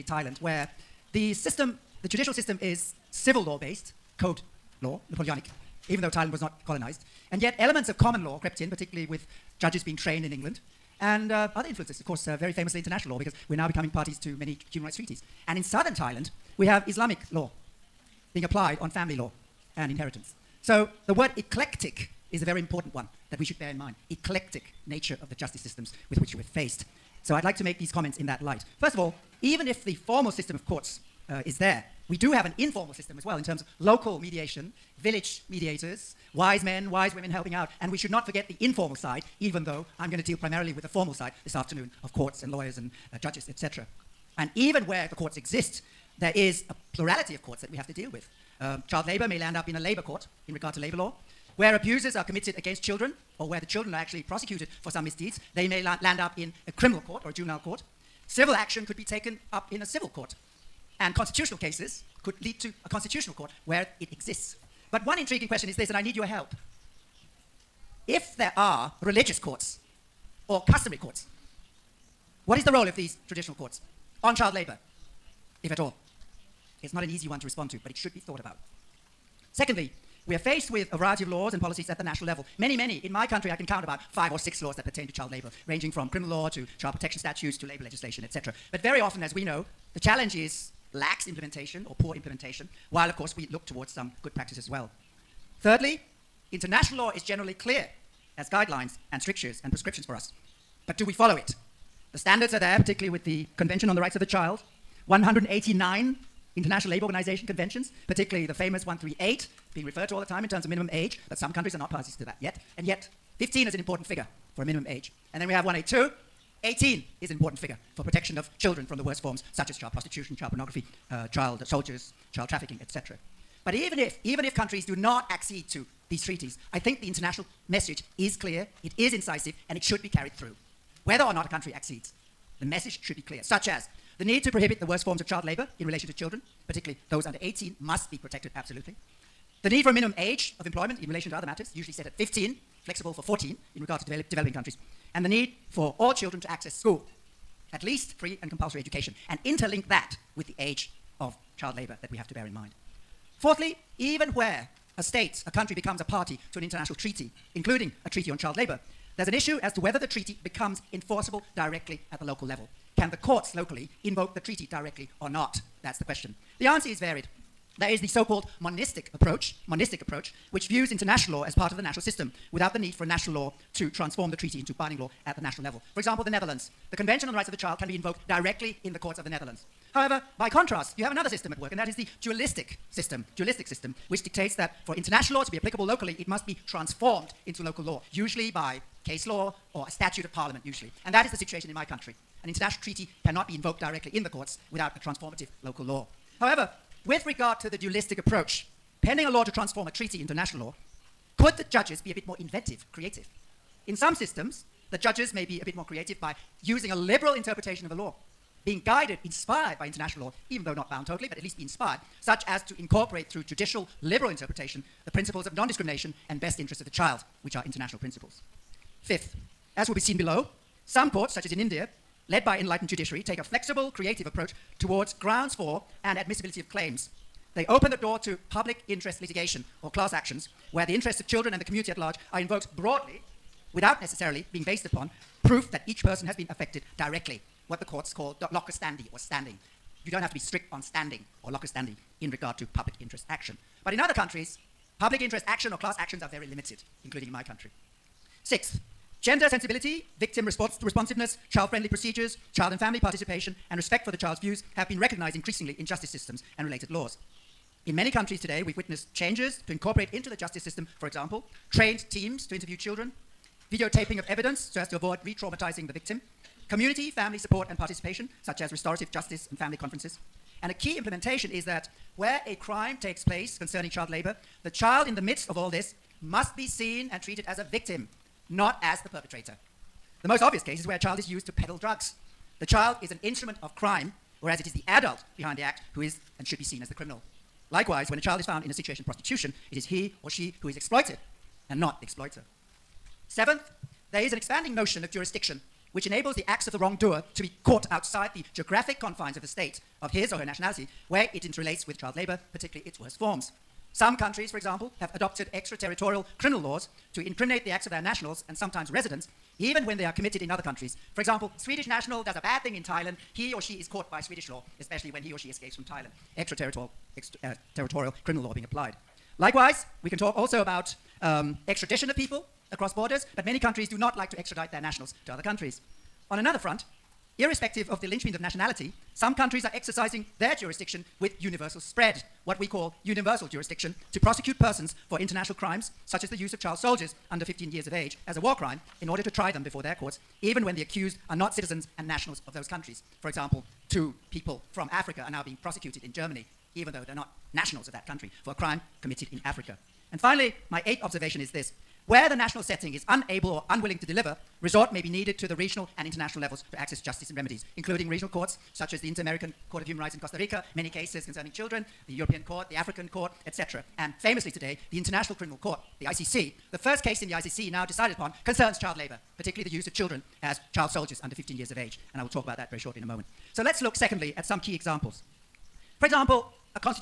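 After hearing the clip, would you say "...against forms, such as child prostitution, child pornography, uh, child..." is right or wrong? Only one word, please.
wrong.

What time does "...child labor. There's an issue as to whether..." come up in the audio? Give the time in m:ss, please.
2:38.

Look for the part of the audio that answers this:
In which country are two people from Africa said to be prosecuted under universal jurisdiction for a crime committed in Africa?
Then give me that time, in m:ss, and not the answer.
5:46.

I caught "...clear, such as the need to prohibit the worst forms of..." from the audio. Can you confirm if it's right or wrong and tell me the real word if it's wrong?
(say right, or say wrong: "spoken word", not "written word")
right.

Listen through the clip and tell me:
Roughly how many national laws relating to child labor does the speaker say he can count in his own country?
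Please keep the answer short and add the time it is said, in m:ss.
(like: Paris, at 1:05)
5 or 6, at 1:24.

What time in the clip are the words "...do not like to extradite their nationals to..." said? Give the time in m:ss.
5:23.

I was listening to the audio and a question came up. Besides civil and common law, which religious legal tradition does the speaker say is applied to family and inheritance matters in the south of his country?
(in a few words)
Islamic law.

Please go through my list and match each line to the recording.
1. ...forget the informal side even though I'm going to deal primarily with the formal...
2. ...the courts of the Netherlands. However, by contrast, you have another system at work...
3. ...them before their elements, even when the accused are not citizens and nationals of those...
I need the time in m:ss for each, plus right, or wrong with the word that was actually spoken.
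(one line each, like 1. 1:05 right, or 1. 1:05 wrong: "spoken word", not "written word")
1. 0:38 right
2. 2:58 right
3. 5:39 wrong: "courts", not "elements".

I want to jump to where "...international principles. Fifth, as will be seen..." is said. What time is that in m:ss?
3:37.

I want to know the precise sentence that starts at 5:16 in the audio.
Extraterritorial uh, criminal law being applied.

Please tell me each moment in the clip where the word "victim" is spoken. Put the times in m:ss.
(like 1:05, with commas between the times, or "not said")
4:10, 4:25, 4:37.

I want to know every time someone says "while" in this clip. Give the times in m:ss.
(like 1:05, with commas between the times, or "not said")
1:32.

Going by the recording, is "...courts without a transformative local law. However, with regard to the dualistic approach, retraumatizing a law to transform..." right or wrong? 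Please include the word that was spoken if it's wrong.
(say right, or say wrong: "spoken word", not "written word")
wrong: "pending", not "retraumatizing".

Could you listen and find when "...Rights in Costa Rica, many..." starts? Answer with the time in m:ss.
5:59.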